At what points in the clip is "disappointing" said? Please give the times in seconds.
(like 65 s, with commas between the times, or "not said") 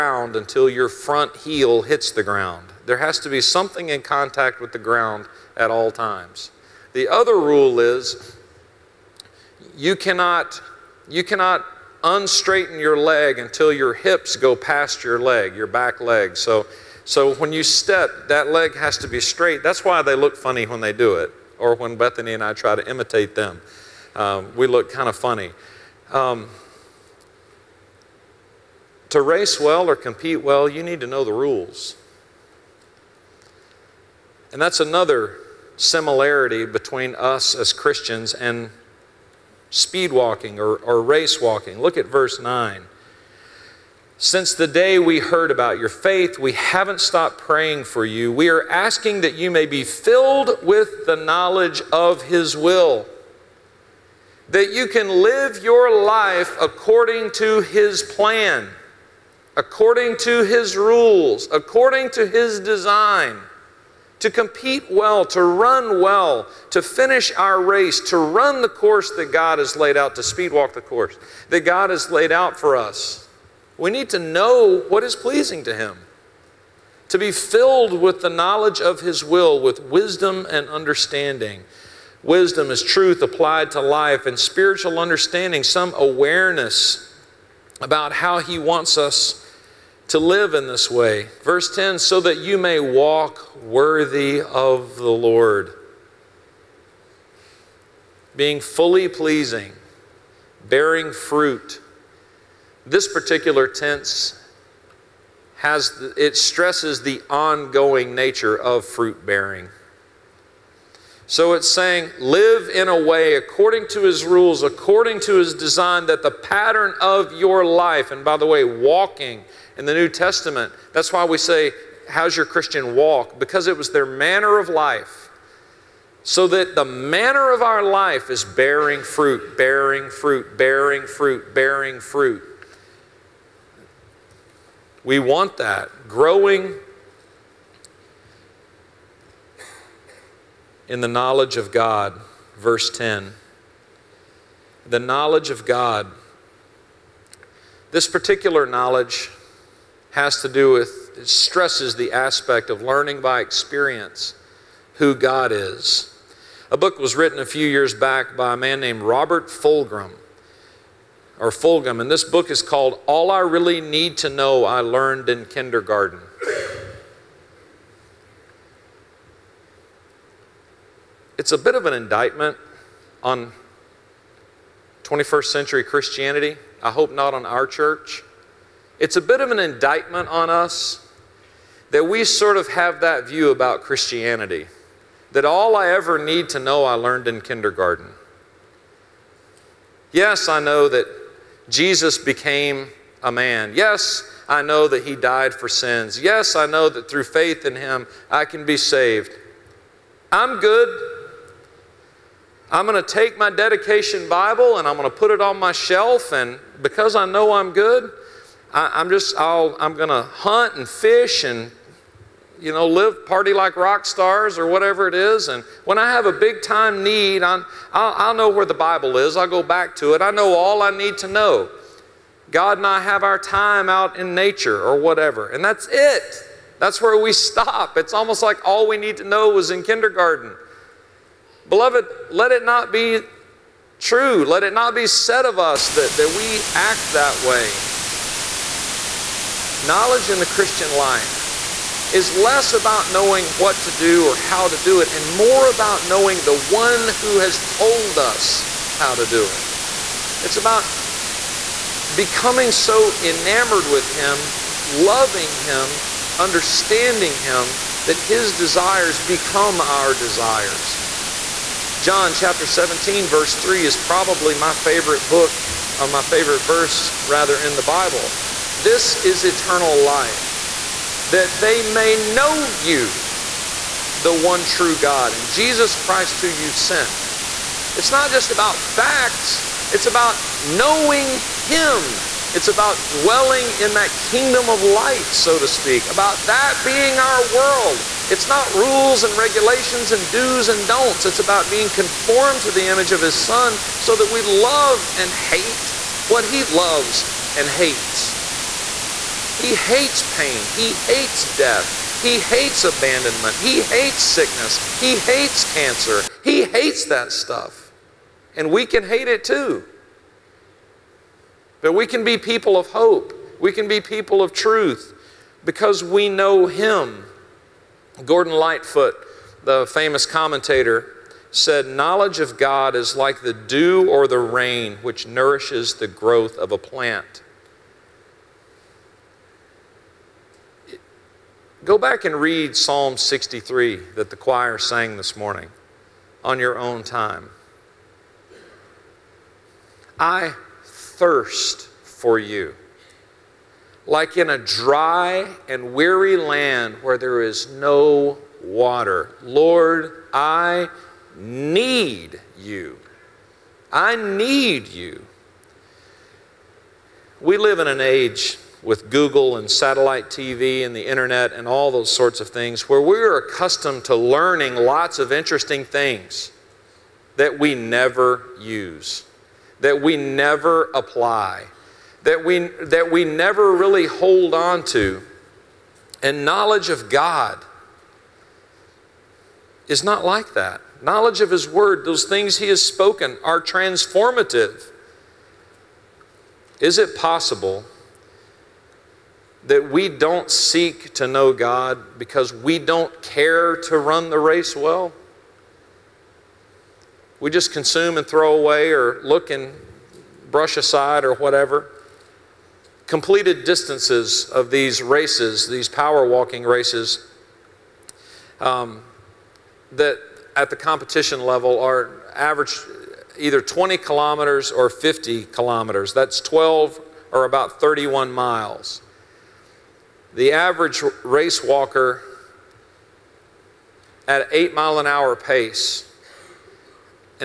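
not said.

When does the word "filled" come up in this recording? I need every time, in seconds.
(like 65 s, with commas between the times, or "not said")
49 s, 77 s.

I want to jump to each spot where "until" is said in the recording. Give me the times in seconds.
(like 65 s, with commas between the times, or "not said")
0 s, 13 s.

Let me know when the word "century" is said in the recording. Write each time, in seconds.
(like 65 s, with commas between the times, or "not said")
175 s.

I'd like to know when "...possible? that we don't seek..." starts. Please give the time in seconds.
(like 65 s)
387 s.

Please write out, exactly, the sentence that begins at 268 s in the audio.
This is eternal life, that they may know you, the one true God, and Jesus Christ who you've sent.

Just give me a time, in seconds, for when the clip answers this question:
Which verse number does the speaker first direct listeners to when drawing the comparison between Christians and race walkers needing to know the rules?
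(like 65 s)
42 s.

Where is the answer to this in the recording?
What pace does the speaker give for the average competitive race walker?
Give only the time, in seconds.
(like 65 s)
424 s.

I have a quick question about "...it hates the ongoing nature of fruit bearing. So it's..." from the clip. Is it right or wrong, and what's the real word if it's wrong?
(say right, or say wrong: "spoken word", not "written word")
wrong: "stresses", not "hates".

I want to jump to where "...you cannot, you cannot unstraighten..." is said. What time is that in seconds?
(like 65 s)
9 s.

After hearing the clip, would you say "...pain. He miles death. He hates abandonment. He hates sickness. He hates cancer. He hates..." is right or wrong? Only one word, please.
wrong.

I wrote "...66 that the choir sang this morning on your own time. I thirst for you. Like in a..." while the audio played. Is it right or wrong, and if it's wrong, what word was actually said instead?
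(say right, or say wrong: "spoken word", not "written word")
wrong: "63", not "66".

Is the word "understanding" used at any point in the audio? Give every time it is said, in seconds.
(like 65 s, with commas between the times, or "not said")
80 s, 84 s, 256 s.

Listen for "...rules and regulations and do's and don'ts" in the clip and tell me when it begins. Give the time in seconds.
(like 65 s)
288 s.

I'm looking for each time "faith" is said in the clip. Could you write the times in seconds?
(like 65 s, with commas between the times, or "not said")
45 s, 197 s.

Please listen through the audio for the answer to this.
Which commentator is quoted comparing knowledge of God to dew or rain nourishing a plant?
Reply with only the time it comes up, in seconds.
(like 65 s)
318 s.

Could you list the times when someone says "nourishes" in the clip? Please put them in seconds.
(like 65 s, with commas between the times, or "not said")
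325 s.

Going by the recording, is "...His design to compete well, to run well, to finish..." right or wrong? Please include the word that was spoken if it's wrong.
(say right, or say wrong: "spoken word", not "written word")
right.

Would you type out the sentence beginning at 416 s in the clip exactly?
That's 12 or about 31 miles.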